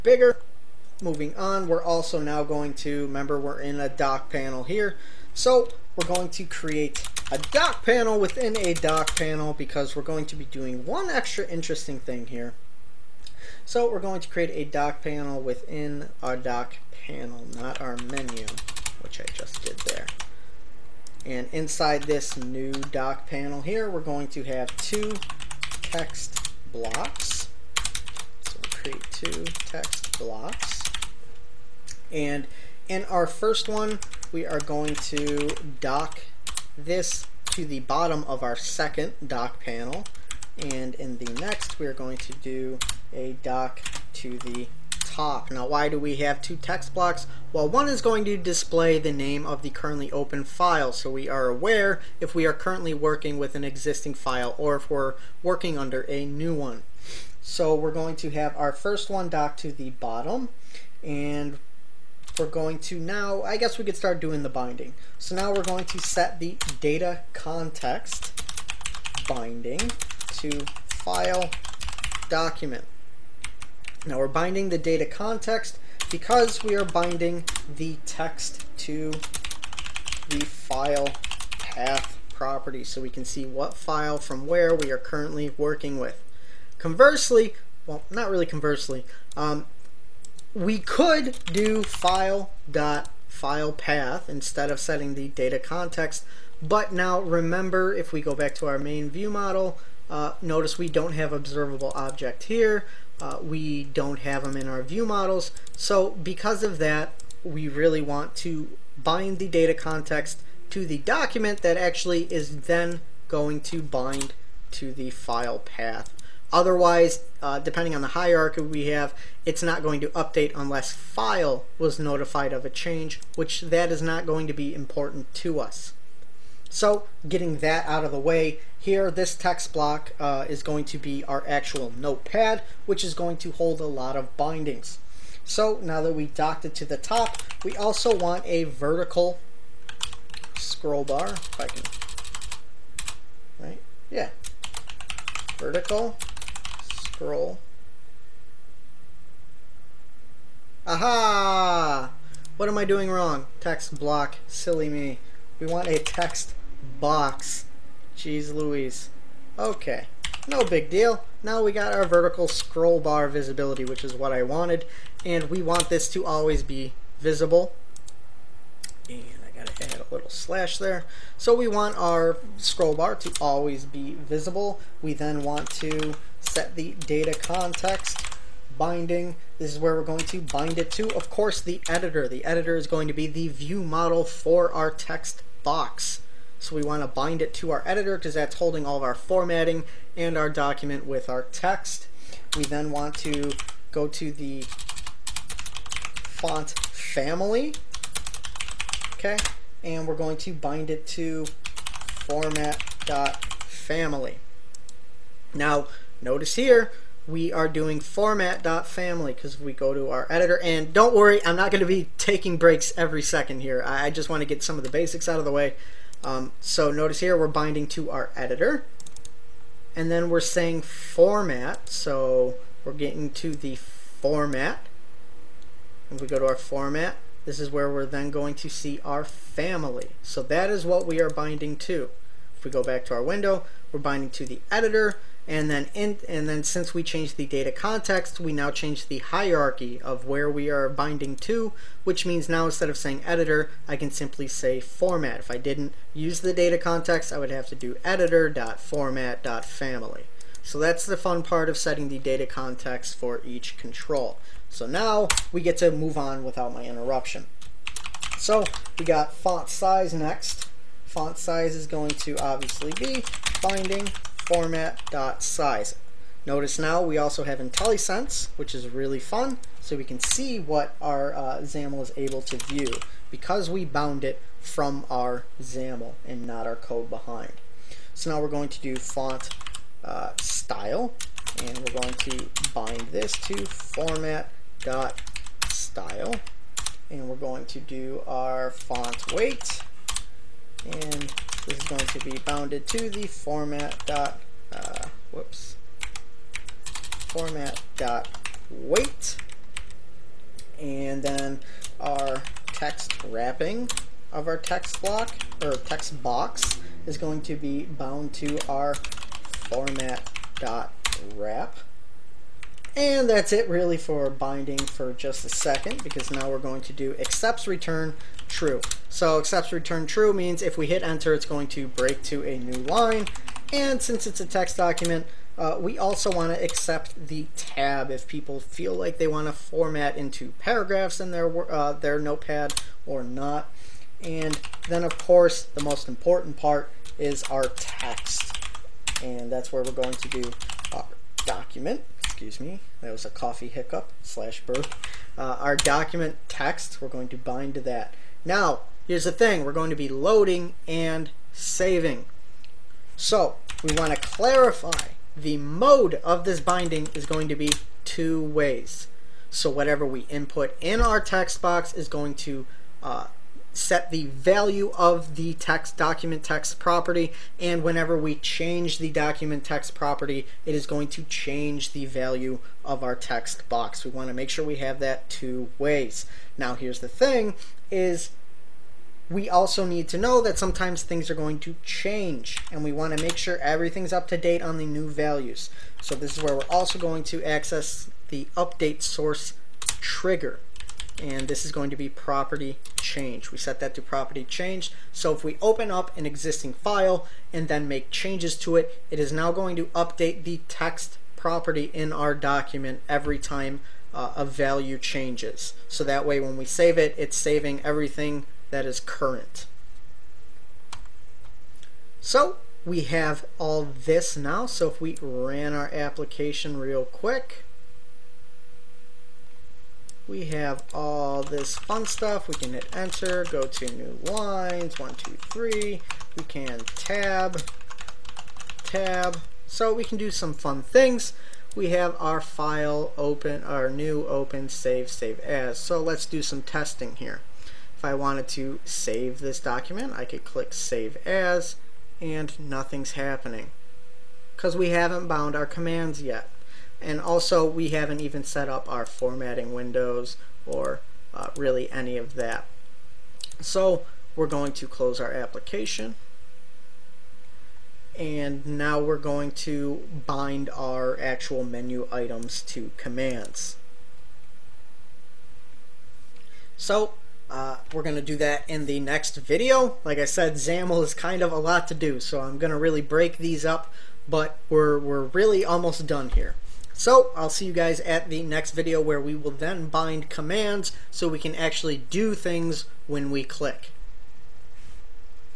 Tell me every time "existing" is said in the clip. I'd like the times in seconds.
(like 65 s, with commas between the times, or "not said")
53 s, 396 s.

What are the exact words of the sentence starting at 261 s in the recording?
Font size is going to obviously be binding format.size.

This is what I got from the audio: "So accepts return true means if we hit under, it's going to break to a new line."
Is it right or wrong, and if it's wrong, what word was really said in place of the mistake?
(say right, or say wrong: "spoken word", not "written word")
wrong: "enter", not "under".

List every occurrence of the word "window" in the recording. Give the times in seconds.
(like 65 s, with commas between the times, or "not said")
233 s, 449 s.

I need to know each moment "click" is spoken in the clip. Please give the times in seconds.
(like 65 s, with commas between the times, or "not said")
440 s, 483 s.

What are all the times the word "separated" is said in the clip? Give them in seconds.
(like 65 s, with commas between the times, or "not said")
not said.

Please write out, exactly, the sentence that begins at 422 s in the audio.
We can hit enter, go to new lines, one, two, three.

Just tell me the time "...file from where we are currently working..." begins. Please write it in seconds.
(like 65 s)
83 s.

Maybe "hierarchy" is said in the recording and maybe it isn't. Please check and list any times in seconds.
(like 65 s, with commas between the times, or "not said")
118 s, 239 s.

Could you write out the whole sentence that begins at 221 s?
So we're getting to the format.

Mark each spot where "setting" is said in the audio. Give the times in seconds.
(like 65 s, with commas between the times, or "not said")
94 s, 251 s.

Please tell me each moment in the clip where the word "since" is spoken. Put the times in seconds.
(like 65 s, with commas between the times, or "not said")
236 s, 324 s.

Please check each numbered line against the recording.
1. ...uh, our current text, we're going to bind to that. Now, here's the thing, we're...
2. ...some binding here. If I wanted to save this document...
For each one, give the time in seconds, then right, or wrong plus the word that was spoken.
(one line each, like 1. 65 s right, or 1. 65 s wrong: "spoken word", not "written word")
1. 345 s wrong: "document", not "current"
2. 436 s wrong: "testing", not "binding".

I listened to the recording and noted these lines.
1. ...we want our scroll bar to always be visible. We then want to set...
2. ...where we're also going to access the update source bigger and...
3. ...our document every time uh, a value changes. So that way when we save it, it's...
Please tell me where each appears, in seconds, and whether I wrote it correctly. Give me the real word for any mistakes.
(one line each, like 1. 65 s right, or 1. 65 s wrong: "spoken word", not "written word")
1. 171 s right
2. 386 s wrong: "trigger", not "bigger"
3. 402 s right.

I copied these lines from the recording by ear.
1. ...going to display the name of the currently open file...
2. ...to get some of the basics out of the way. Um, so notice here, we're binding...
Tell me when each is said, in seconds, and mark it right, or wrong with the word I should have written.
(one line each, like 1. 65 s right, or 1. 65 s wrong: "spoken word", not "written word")
1. 48 s right
2. 214 s right.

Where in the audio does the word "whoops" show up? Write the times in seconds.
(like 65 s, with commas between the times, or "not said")
295 s.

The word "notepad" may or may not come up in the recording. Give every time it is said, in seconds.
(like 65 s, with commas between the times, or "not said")
131 s, 332 s.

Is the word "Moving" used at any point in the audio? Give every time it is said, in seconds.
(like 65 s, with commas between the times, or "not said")
1 s.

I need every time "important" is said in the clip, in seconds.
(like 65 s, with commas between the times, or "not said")
124 s, 336 s.